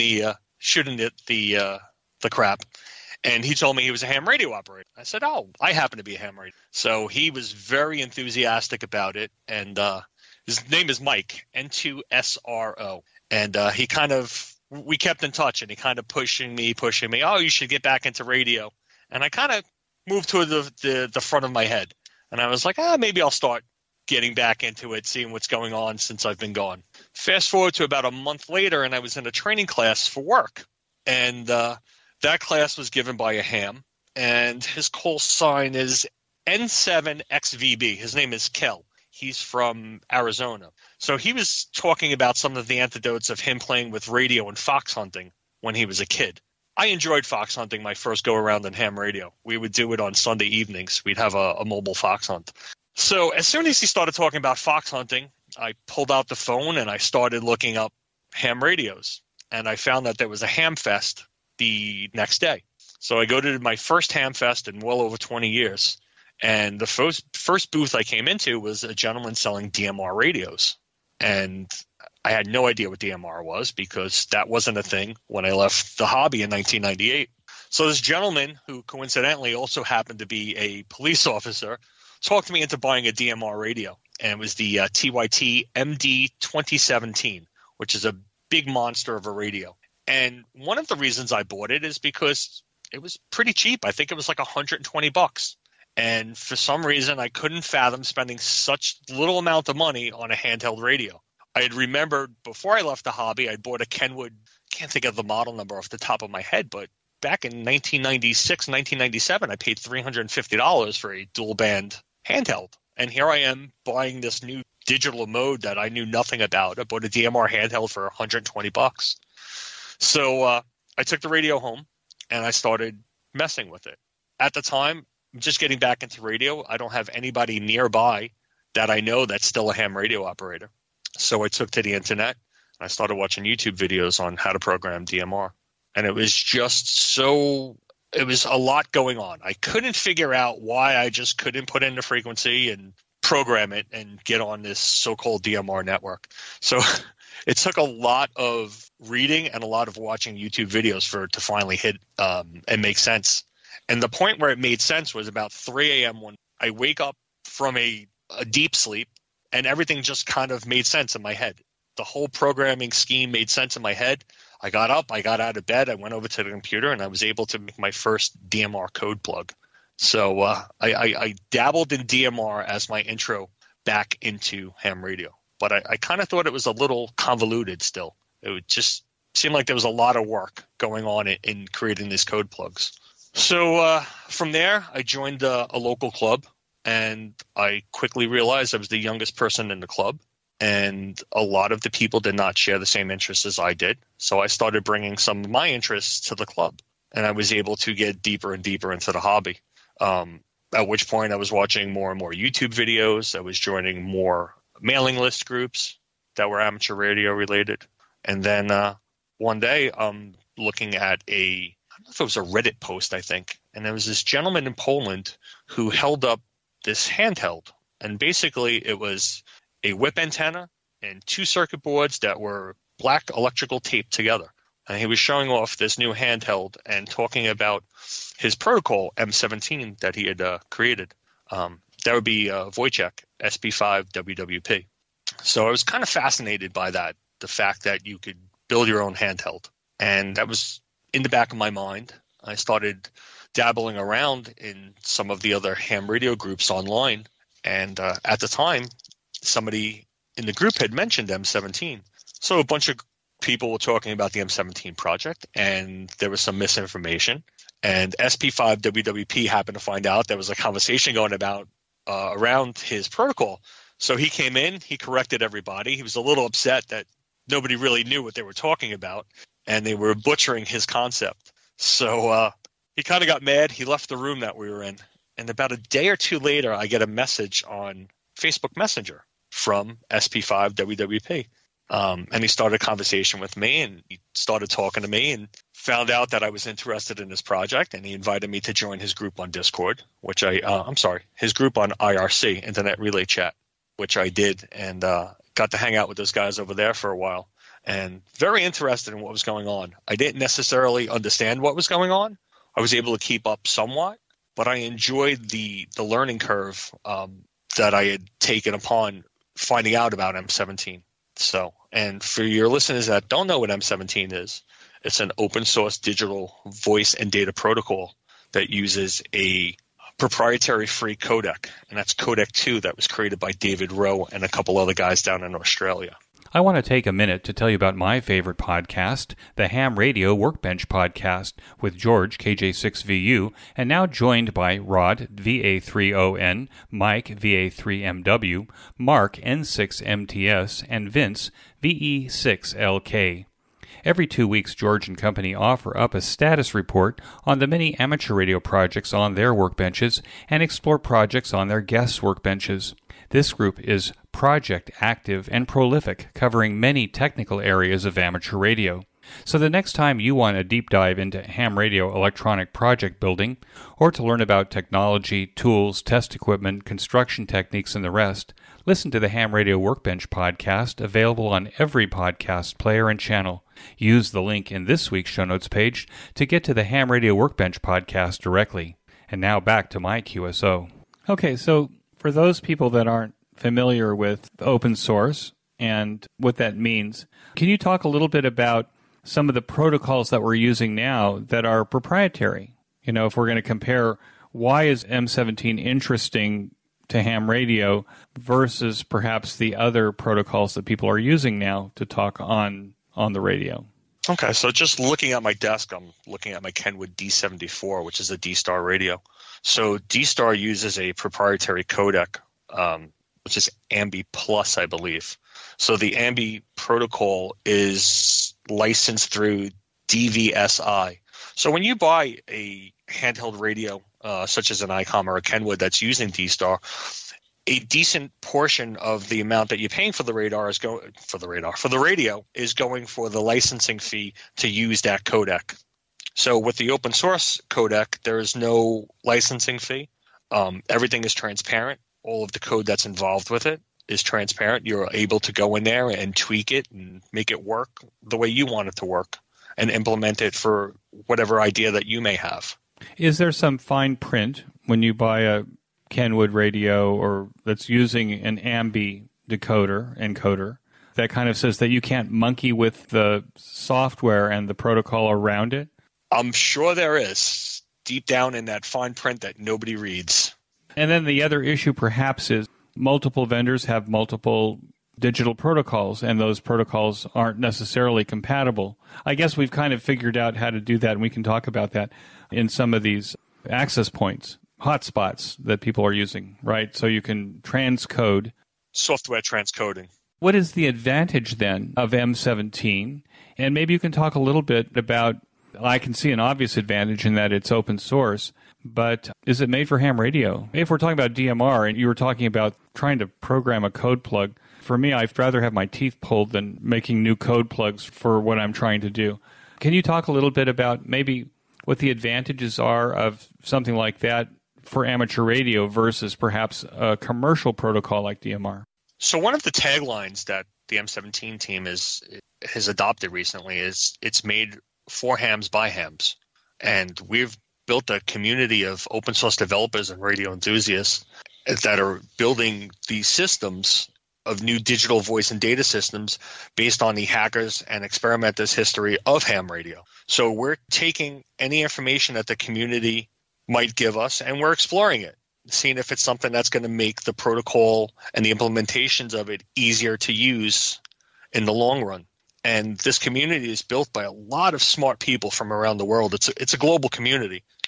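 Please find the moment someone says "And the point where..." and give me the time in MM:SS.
02:33.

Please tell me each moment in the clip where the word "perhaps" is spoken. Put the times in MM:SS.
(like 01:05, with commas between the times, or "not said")
06:39, 07:51, 08:36.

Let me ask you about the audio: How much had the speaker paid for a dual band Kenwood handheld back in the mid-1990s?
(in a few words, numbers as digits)
$350.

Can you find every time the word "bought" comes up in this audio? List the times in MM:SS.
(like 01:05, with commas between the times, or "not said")
01:31, 01:43, 01:56.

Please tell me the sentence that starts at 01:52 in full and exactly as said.
And here I am buying this new digital mode that I knew nothing about.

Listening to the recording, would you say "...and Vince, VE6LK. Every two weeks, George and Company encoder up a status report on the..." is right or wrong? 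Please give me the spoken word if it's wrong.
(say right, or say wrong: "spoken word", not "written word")
wrong: "offer", not "encoder".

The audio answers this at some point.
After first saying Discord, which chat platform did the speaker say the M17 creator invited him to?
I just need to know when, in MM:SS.
04:51.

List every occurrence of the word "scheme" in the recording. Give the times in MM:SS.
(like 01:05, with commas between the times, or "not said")
02:42.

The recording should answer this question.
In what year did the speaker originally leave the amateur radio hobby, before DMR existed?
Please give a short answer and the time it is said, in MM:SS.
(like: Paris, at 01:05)
1998, at 01:16.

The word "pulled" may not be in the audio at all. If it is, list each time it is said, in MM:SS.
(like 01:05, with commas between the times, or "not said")
00:55, 08:26.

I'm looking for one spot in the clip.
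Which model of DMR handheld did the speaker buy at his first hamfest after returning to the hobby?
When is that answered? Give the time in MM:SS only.
01:24.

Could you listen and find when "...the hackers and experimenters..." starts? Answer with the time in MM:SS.
08:57.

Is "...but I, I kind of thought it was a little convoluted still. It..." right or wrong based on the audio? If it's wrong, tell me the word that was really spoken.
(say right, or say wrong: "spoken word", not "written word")
right.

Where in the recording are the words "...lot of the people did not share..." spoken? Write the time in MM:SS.
03:11.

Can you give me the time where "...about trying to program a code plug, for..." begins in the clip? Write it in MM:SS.
08:22.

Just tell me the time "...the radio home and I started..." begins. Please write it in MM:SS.
02:01.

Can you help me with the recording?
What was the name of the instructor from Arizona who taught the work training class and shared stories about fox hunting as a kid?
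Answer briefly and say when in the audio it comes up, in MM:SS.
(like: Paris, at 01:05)
Kel, at 00:38.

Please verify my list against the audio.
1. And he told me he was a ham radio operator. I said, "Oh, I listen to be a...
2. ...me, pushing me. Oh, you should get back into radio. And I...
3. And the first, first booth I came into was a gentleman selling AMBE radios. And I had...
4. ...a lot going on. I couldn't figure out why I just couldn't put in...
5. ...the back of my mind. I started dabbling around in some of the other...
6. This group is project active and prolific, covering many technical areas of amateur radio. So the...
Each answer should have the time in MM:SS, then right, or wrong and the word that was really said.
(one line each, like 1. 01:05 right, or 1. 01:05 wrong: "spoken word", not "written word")
1. 00:03 wrong: "happen", not "listen"
2. 00:16 right
3. 01:06 wrong: "DMR", not "AMBE"
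4. 02:18 right
5. 04:01 right
6. 05:53 right.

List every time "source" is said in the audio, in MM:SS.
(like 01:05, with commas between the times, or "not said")
05:15, 06:24, 07:17, 08:17, 08:49.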